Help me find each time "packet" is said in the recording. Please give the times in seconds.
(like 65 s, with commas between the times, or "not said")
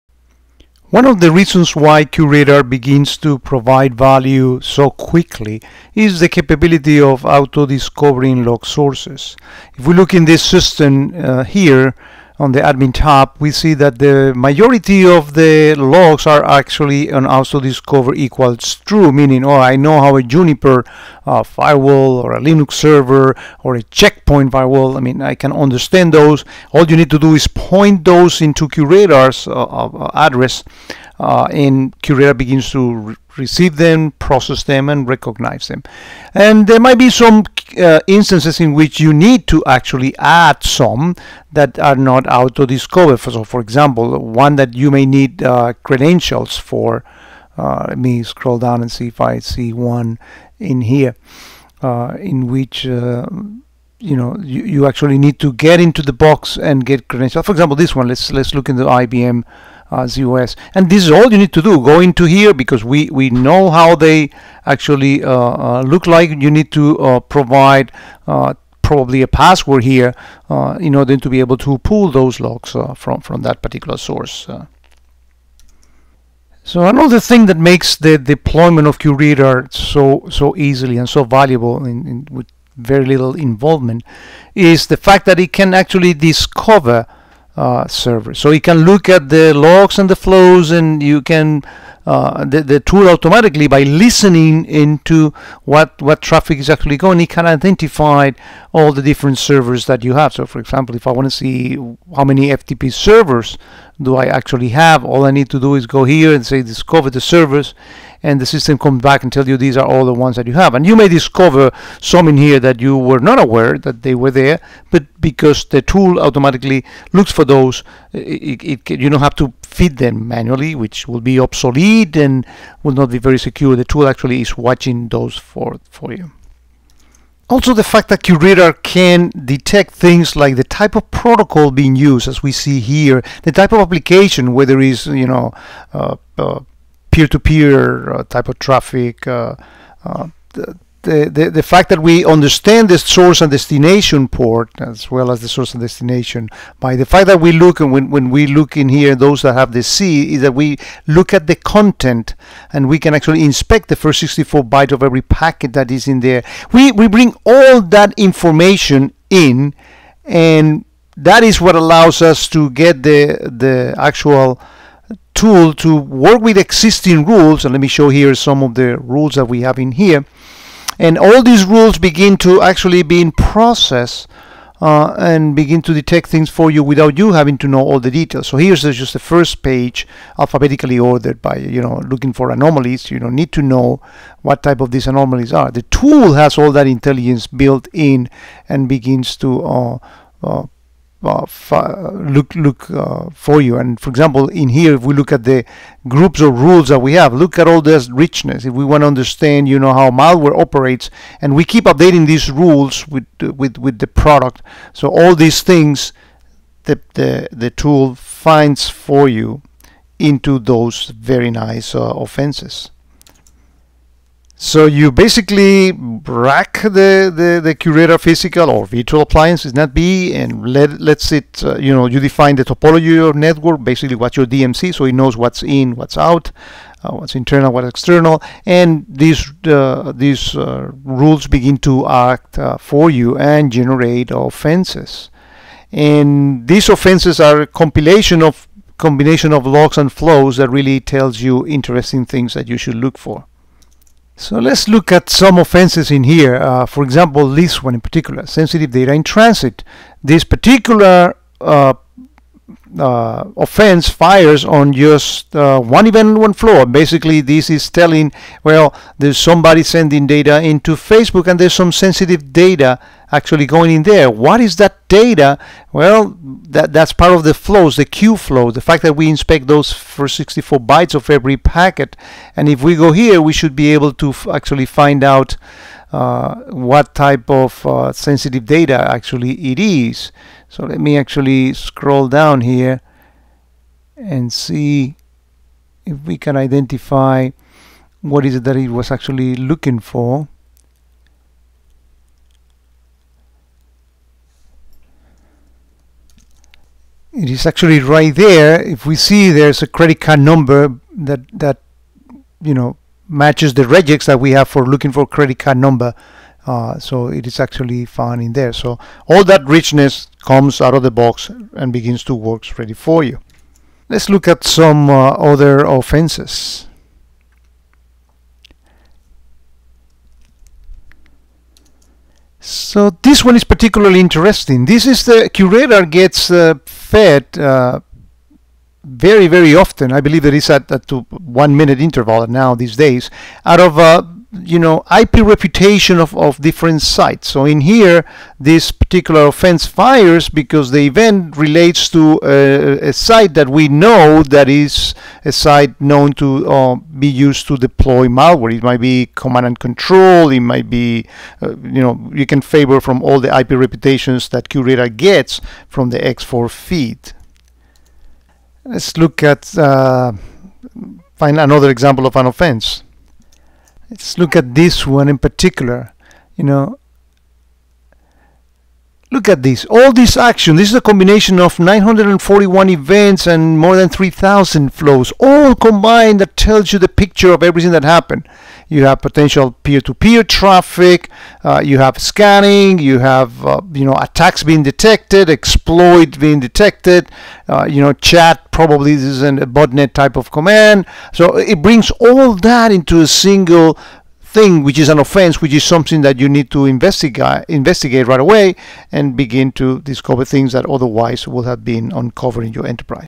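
155 s, 271 s.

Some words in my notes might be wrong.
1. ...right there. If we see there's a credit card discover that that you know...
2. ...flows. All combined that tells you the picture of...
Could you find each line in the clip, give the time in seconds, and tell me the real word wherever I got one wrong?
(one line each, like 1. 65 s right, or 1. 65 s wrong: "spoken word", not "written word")
1. 298 s wrong: "number", not "discover"
2. 374 s right.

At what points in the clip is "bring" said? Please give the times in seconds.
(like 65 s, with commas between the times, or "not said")
157 s, 391 s.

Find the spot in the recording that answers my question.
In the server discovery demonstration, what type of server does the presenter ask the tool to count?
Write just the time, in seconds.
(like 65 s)
102 s.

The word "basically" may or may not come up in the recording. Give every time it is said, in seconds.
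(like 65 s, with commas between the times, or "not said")
215 s, 223 s, 256 s.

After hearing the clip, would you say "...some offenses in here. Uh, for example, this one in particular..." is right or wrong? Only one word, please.
right.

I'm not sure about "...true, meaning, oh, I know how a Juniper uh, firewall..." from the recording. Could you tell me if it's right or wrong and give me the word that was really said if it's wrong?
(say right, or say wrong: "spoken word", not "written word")
right.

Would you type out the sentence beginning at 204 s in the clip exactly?
So all these things, the the the tool finds for you into those very nice uh, offenses.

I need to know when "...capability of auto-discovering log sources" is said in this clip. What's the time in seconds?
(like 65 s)
6 s.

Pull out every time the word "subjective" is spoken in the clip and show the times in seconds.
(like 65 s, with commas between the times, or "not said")
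not said.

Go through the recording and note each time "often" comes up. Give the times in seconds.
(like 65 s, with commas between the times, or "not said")
329 s.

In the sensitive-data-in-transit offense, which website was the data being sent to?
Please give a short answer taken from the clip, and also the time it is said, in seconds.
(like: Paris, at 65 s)
Facebook, at 260 s.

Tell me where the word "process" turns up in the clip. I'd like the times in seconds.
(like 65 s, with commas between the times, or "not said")
34 s, 173 s.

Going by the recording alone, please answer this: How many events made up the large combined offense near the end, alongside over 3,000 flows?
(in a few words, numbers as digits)
941.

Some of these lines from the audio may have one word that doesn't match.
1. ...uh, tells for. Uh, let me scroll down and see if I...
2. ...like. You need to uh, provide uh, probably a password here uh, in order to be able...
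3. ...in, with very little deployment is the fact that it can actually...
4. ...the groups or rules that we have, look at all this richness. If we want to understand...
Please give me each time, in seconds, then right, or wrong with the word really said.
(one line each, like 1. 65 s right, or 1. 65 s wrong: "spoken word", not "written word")
1. 45 s wrong: "credentials", not "tells"
2. 66 s right
3. 82 s wrong: "involvement", not "deployment"
4. 195 s right.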